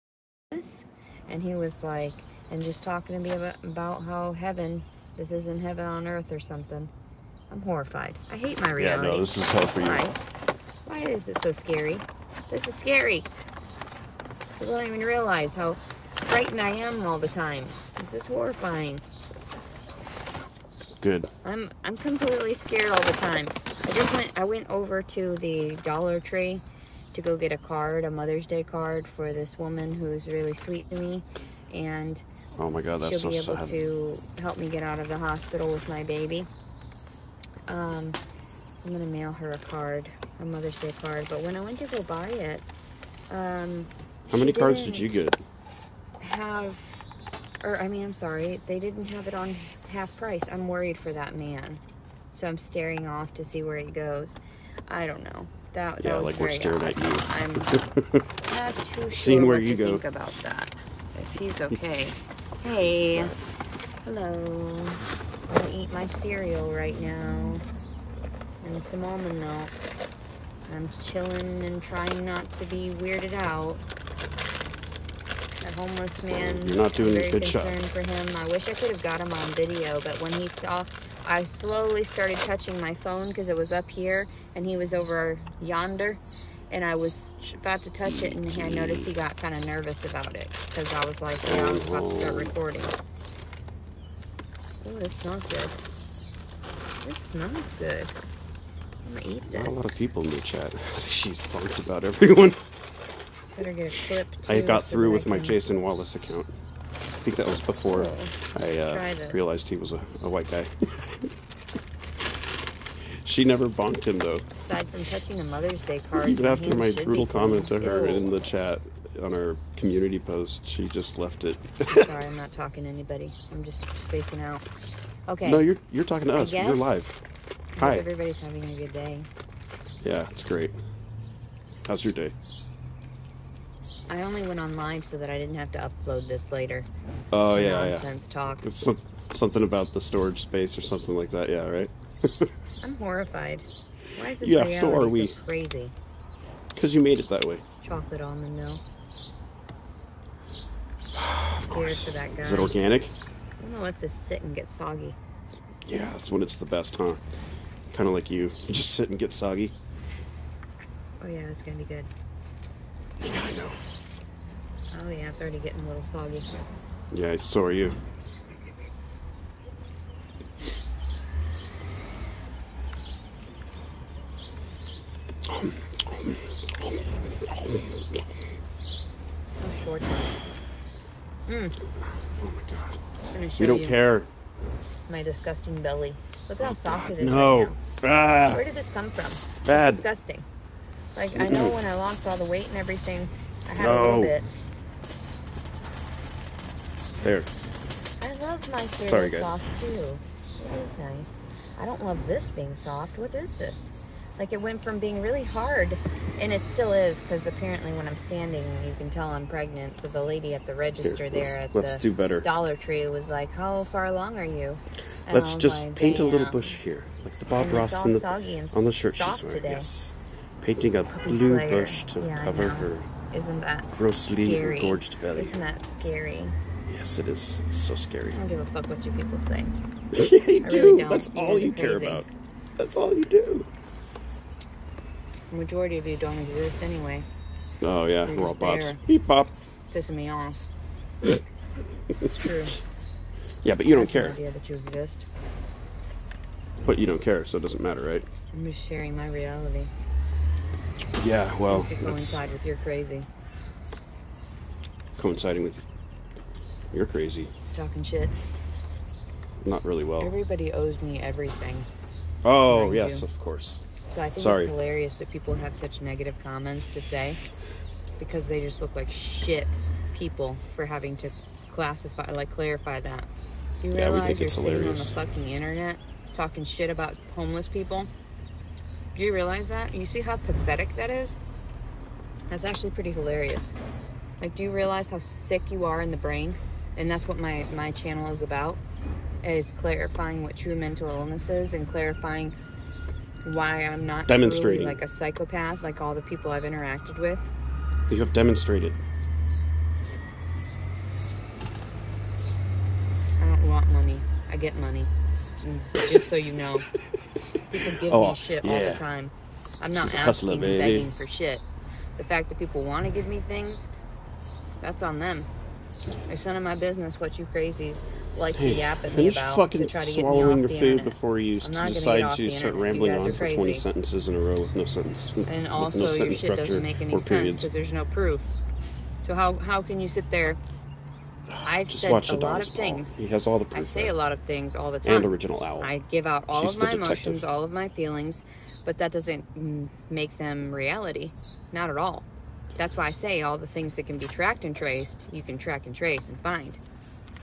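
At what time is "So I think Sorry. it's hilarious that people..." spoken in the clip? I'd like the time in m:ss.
4:24.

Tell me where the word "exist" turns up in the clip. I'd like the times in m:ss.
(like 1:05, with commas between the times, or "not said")
3:56, 4:04.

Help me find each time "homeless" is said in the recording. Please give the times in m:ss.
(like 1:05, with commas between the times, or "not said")
1:15, 4:37.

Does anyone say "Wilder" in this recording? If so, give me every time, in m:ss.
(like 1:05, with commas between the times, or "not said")
not said.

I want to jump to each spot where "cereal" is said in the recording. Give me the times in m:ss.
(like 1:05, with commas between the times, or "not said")
1:06, 3:18.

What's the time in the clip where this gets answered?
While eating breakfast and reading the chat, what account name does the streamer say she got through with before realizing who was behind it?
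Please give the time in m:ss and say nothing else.
1:45.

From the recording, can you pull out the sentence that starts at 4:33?
You yeah, realize you're sitting hilarious.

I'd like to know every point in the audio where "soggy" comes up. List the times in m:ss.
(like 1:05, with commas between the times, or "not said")
2:34, 2:39, 2:46.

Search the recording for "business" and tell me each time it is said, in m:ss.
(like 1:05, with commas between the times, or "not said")
5:16.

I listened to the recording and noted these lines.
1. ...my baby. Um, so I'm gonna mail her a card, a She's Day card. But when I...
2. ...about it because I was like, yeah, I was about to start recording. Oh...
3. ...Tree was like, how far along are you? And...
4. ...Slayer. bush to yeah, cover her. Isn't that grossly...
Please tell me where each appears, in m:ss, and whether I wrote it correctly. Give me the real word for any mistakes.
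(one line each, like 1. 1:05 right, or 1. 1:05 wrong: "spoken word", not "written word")
1. 0:35 wrong: "Mother", not "She"
2. 1:30 right
3. 3:32 right
4. 3:41 right.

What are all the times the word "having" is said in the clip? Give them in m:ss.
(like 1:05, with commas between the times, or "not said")
2:08, 4:30.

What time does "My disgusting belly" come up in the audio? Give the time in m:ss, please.
3:05.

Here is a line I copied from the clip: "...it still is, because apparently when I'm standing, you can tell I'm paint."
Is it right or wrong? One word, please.
wrong.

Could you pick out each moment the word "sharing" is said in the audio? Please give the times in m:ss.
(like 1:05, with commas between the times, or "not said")
4:08.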